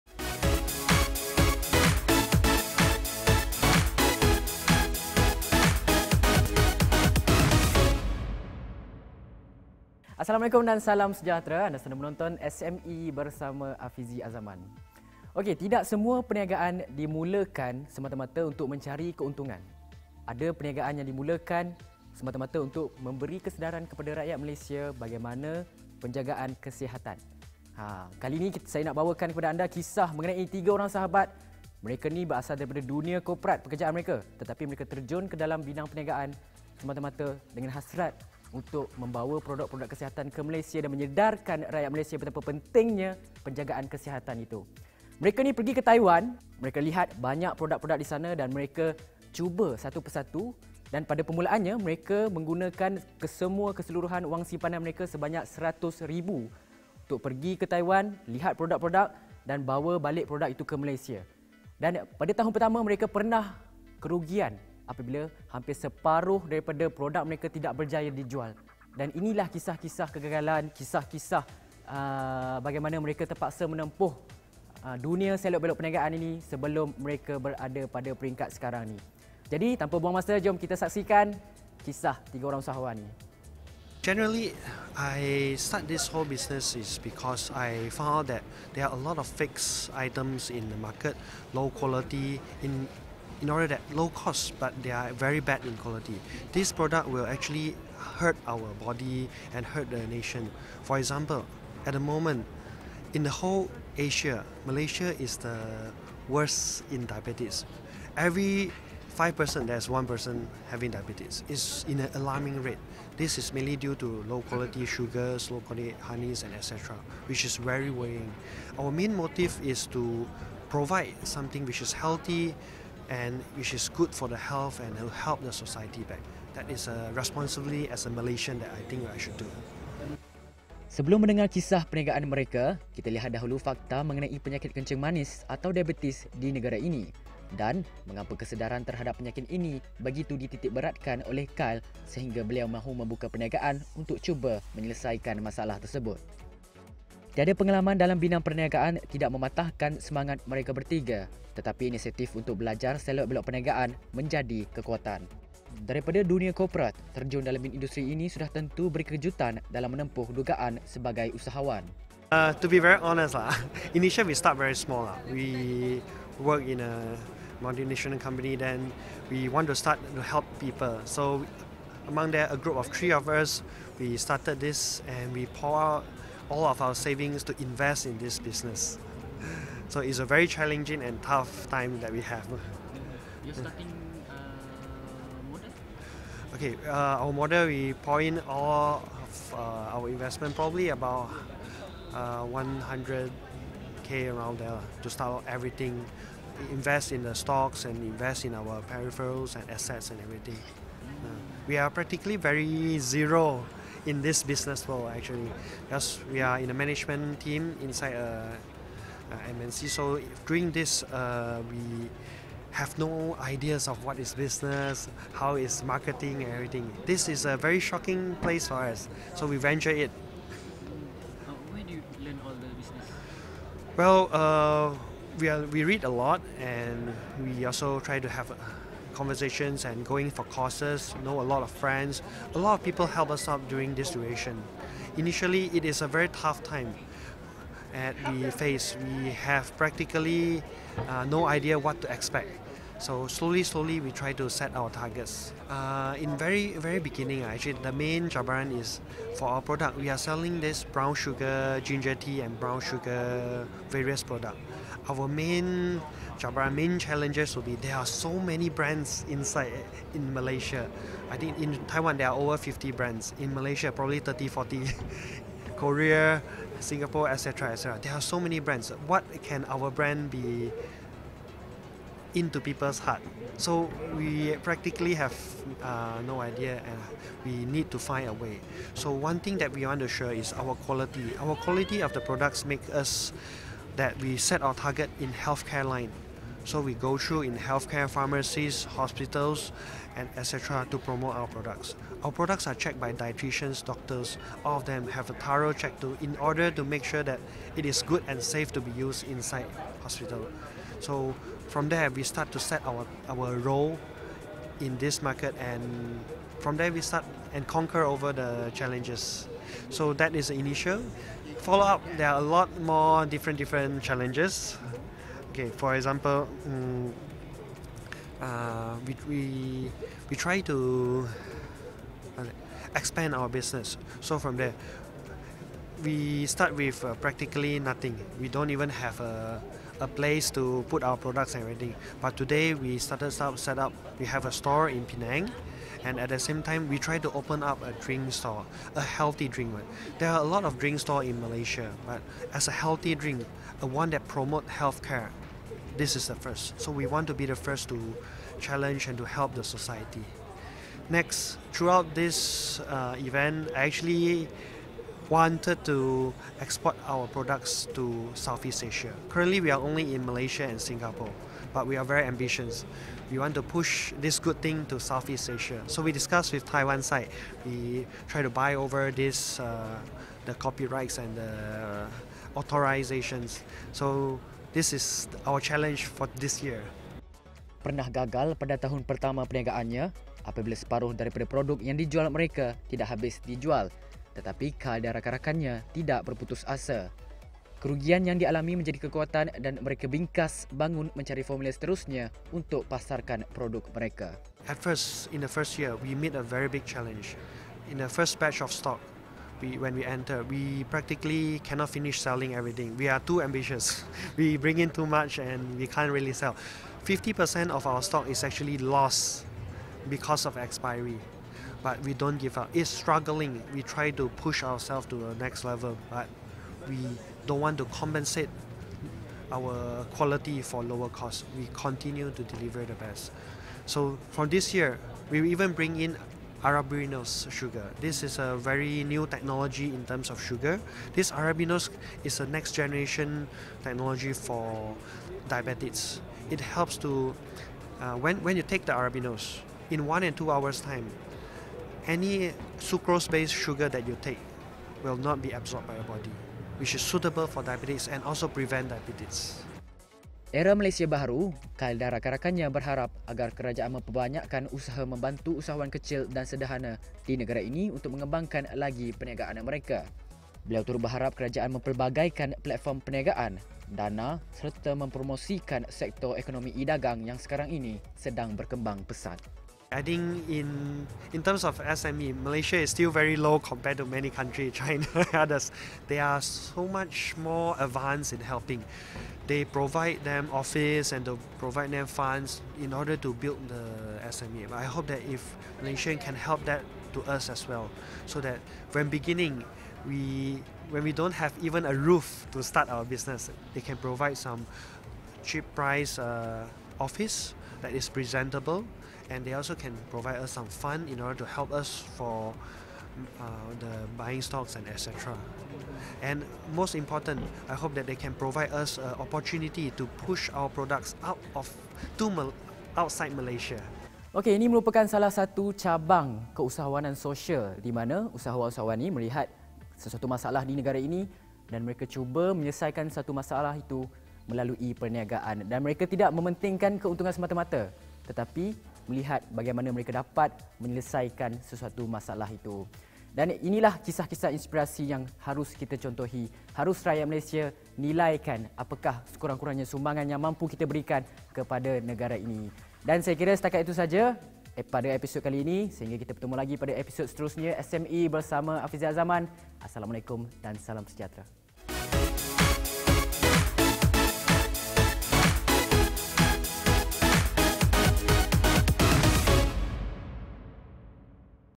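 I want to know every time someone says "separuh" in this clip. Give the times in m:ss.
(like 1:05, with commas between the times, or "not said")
1:05, 6:20.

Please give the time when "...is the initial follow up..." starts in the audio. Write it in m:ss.
5:10.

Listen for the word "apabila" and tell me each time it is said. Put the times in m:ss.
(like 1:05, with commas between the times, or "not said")
1:04, 6:20.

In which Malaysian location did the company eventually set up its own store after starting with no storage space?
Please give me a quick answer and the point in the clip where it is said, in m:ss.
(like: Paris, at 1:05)
Penang, at 5:35.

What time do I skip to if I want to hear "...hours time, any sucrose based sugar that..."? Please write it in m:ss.
7:20.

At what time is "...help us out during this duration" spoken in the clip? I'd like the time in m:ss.
3:53.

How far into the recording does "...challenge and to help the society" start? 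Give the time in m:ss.
5:48.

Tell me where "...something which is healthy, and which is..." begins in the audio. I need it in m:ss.
2:01.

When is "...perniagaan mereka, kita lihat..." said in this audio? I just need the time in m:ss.
2:11.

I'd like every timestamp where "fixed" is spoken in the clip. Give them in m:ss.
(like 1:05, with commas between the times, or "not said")
1:29.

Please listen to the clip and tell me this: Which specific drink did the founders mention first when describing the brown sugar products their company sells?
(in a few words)
brown sugar ginger tea.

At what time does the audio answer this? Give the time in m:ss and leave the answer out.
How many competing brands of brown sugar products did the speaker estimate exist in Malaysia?
4:24.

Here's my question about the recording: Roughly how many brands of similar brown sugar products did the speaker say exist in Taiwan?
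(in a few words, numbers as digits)
over 50.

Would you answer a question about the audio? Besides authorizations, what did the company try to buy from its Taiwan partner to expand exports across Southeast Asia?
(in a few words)
copyrights.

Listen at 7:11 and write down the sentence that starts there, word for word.
This Arabinose is a next generation technology for diabetics.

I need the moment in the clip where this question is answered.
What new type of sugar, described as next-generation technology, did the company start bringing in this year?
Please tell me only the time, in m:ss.
7:06.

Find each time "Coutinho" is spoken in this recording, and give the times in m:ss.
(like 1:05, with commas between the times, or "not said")
not said.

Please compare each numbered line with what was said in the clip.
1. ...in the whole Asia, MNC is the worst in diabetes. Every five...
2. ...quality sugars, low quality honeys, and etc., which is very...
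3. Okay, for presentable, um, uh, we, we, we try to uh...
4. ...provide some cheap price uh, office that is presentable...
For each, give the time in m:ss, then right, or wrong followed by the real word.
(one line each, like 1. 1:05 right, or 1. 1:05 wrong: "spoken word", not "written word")
1. 1:43 wrong: "Malaysia", not "MNC"
2. 1:54 right
3. 5:15 wrong: "example", not "presentable"
4. 8:13 right.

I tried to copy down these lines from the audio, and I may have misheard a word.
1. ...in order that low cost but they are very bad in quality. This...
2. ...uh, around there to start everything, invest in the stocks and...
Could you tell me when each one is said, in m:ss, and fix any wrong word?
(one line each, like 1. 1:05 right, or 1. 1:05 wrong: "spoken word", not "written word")
1. 1:33 right
2. 3:14 right.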